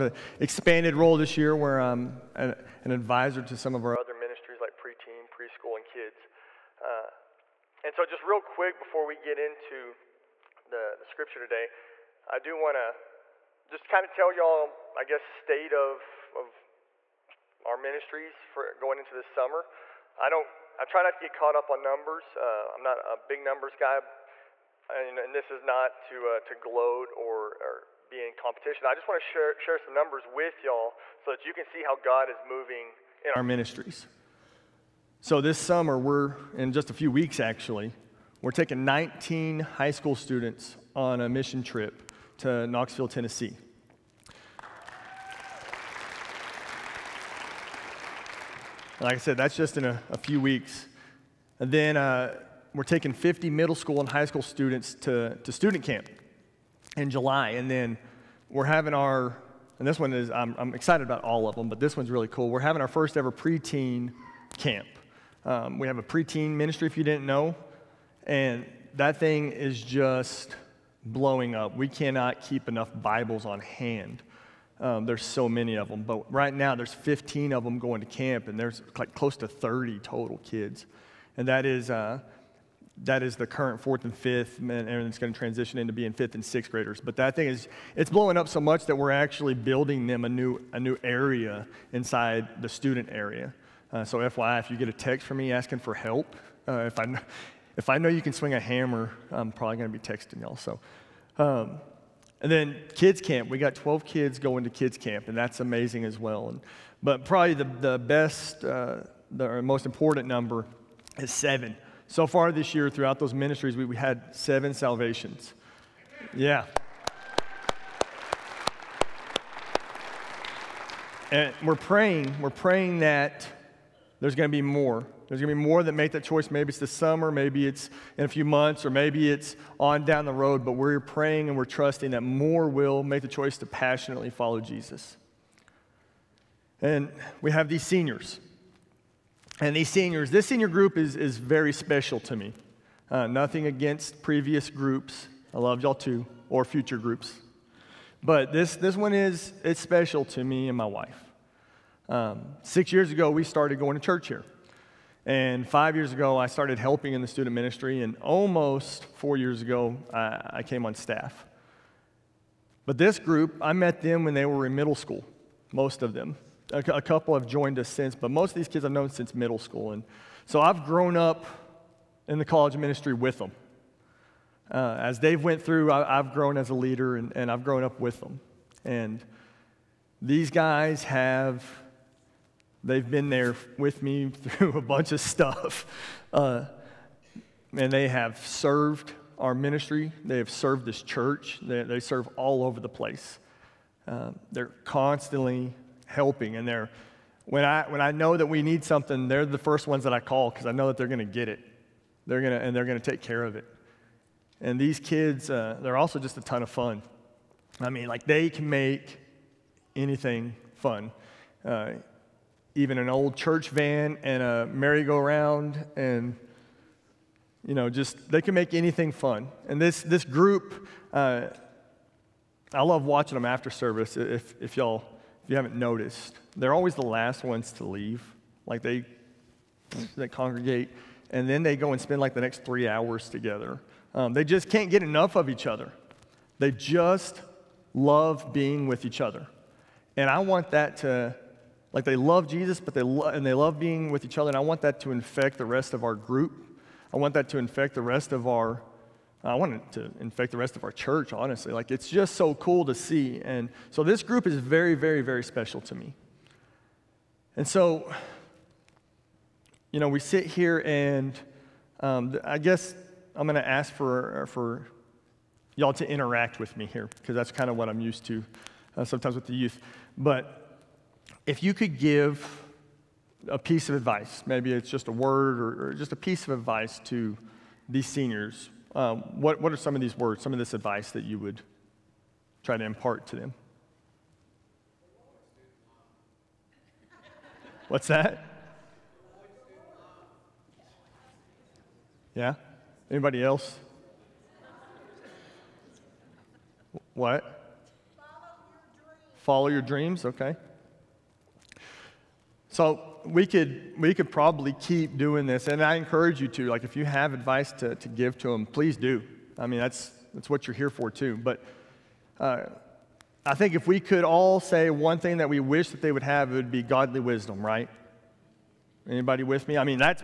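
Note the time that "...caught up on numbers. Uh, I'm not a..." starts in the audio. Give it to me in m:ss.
0:21.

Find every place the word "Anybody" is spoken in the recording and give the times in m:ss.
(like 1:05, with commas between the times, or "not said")
4:53, 5:19.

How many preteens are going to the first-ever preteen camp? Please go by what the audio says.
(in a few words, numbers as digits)
15.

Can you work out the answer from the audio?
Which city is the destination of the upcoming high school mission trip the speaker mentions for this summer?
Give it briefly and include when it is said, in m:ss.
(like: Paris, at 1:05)
Knoxville, Tennessee, at 0:42.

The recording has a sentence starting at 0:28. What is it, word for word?
I just want to share, share some numbers with y'all so that you can see how God is moving in our ministries.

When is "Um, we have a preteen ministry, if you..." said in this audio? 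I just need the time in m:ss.
1:05.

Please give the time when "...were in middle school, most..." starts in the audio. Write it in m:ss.
2:44.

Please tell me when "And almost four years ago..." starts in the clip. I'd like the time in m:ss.
2:38.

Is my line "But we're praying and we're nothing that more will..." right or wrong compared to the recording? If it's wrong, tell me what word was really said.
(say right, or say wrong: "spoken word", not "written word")
wrong: "trusting", not "nothing".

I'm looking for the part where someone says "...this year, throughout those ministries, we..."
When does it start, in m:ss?
1:52.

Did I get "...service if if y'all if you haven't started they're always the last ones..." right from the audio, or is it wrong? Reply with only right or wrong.
wrong.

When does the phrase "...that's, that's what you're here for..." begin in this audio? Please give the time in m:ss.
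5:09.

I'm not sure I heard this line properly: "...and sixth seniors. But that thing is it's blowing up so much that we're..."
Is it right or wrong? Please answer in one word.
wrong.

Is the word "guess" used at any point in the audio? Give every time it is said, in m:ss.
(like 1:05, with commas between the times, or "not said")
0:15, 4:22.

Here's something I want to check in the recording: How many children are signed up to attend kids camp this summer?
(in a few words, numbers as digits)
12.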